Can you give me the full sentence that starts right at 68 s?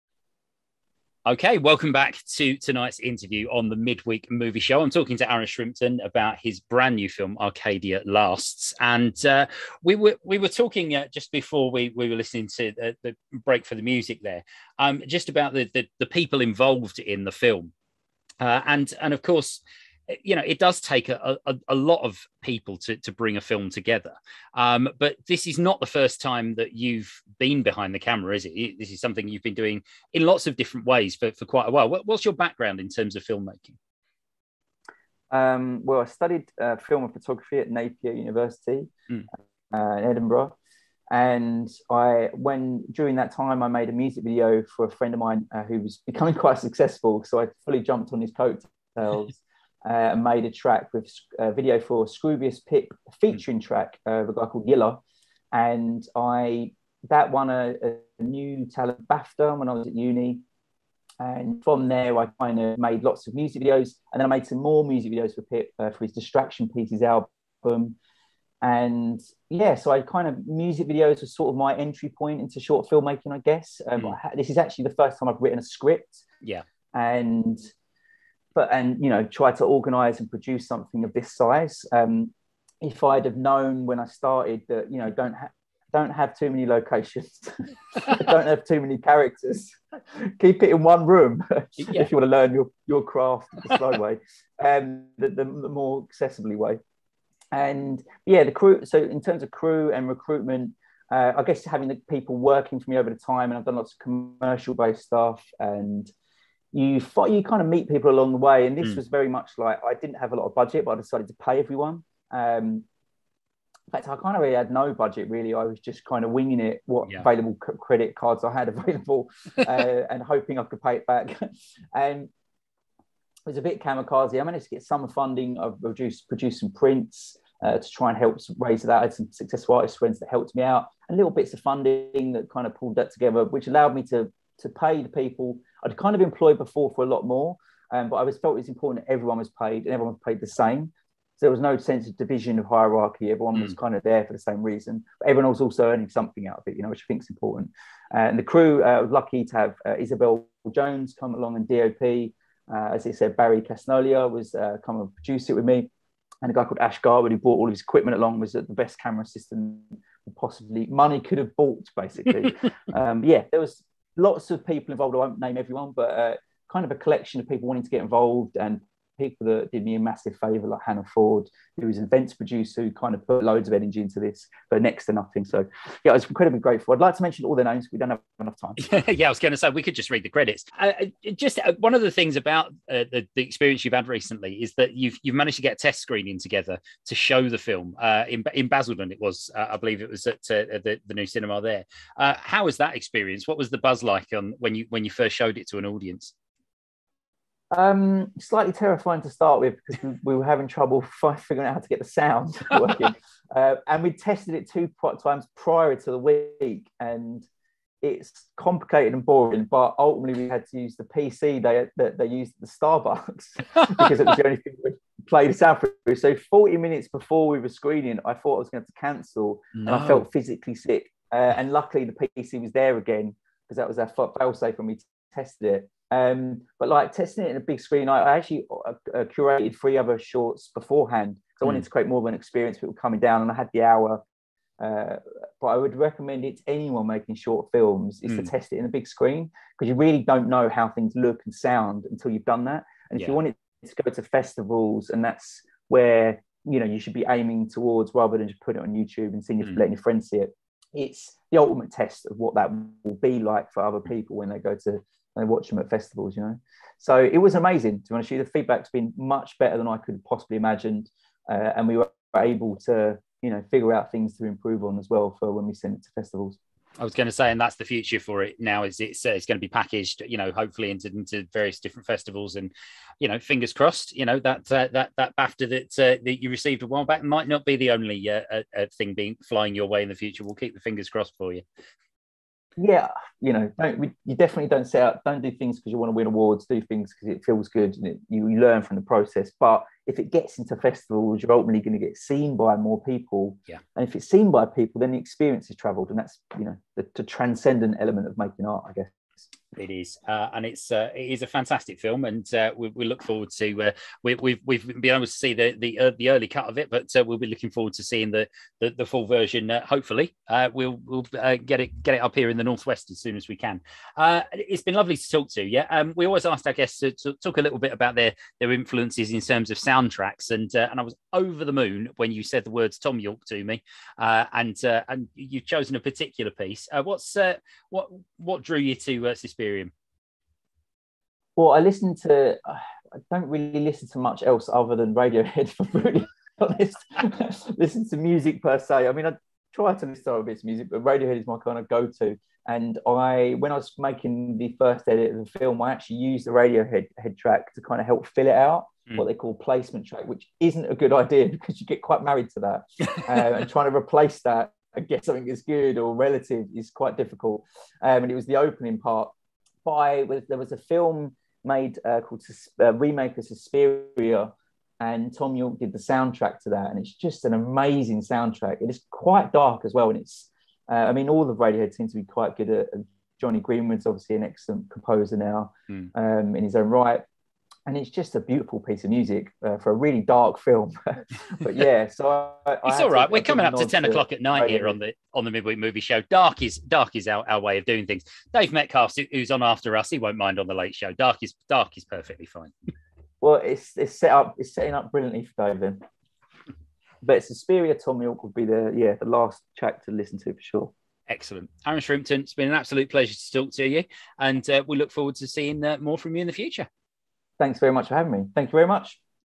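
And yeah, so I kind of music videos was sort of my entry point into short filmmaking, I guess.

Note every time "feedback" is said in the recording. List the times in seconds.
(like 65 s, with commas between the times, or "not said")
258 s.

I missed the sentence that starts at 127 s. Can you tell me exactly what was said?
Uh, to try and help raise that.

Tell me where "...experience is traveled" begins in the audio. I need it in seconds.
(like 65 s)
295 s.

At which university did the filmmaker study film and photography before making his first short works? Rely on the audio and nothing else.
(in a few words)
Napier University.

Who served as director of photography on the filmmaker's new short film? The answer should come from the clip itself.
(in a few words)
Isabel Jones.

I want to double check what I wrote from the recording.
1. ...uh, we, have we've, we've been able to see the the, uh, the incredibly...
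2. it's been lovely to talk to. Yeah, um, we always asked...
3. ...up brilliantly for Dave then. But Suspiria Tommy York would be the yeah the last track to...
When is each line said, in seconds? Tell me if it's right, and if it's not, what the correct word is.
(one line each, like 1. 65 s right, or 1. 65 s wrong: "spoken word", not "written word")
1. 303 s wrong: "early", not "incredibly"
2. 314 s right
3. 394 s right.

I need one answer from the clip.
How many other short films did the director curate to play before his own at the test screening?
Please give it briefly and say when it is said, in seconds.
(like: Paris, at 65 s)
3, at 229 s.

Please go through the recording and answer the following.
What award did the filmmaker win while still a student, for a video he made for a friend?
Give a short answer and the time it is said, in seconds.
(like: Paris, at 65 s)
new talent BAFTA, at 58 s.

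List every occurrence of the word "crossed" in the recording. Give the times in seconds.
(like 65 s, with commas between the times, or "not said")
273 s, 281 s.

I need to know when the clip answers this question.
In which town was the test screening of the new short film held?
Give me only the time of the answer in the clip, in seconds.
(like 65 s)
188 s.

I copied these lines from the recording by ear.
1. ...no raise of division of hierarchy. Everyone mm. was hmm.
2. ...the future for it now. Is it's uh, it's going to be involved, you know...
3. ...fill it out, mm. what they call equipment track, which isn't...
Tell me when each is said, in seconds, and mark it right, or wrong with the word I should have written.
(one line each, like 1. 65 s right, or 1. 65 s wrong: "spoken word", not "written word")
1. 141 s wrong: "sense", not "raise"
2. 267 s wrong: "packaged", not "involved"
3. 348 s wrong: "placement", not "equipment".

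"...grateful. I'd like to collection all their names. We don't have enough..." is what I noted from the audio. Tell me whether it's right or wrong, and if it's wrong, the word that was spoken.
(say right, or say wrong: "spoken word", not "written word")
wrong: "mention", not "collection".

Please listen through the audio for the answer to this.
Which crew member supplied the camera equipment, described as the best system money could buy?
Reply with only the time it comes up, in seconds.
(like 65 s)
156 s.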